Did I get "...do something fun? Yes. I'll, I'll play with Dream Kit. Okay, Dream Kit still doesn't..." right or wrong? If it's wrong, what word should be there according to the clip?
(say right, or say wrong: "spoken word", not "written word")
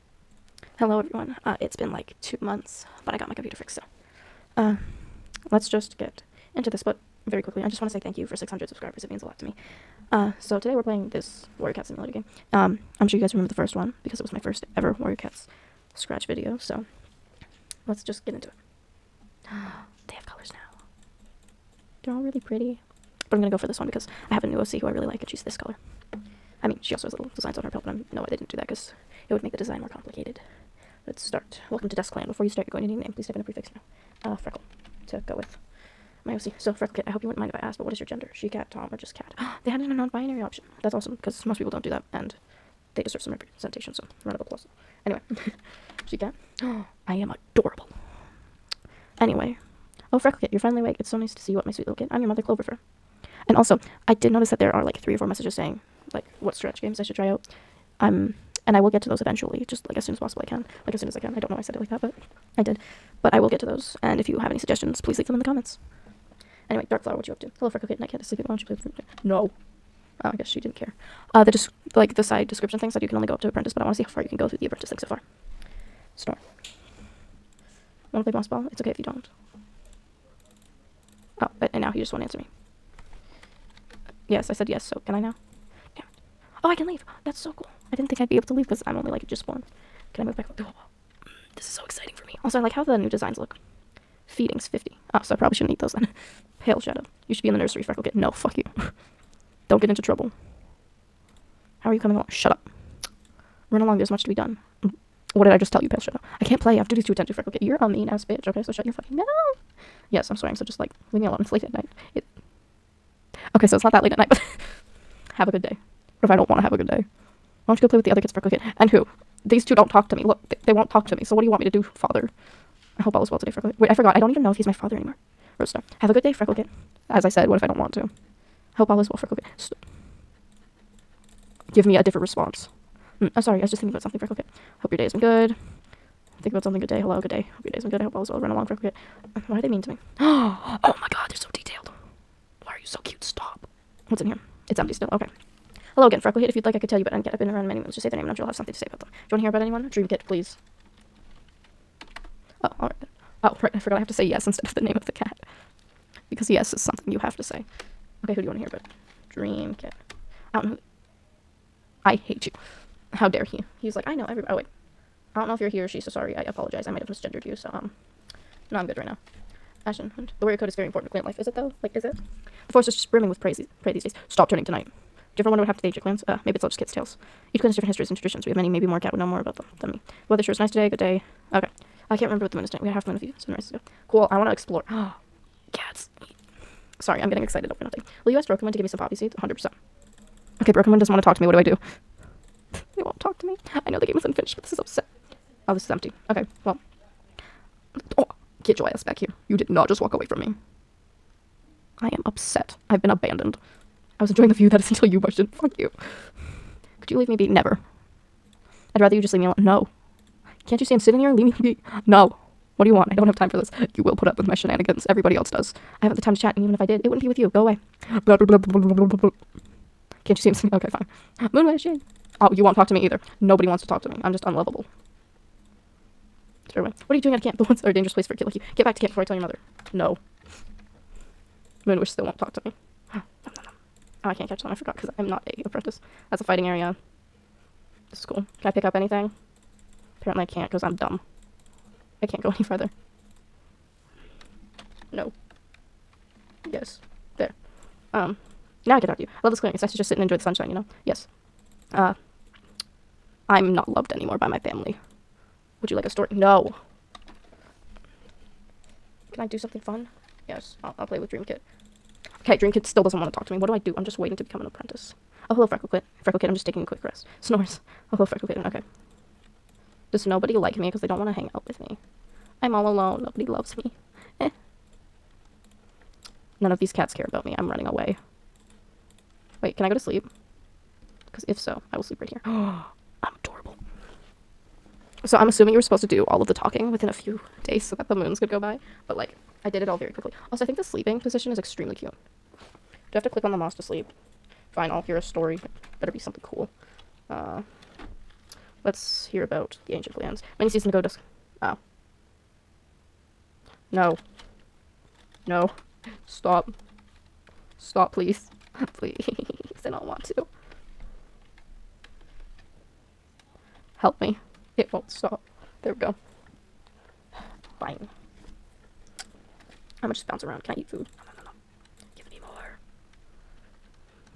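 right.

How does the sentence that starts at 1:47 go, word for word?
You're a mean ass bitch, okay?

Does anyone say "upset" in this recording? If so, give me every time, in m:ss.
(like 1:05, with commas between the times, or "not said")
3:14, 3:22.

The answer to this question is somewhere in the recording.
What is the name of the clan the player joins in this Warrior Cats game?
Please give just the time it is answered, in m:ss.
0:31.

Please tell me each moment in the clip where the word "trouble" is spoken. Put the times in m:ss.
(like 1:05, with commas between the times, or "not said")
1:40.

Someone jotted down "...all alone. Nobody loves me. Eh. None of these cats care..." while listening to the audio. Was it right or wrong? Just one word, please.
right.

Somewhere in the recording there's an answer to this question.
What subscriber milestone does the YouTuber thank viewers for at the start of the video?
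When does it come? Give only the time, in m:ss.
0:08.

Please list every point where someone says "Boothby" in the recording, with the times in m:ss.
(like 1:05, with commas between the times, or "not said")
not said.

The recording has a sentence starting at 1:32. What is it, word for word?
Also, I like how the new designs look.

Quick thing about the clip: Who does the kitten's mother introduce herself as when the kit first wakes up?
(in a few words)
Cloverfur.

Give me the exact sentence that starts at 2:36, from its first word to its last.
Because yes is something you have to say.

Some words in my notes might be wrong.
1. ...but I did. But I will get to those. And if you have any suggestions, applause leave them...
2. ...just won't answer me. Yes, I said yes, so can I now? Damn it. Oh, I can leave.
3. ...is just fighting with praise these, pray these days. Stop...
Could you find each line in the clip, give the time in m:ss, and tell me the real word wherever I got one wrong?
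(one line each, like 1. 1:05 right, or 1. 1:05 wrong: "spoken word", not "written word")
1. 1:02 wrong: "please", not "applause"
2. 1:21 right
3. 2:52 wrong: "brimming", not "fighting".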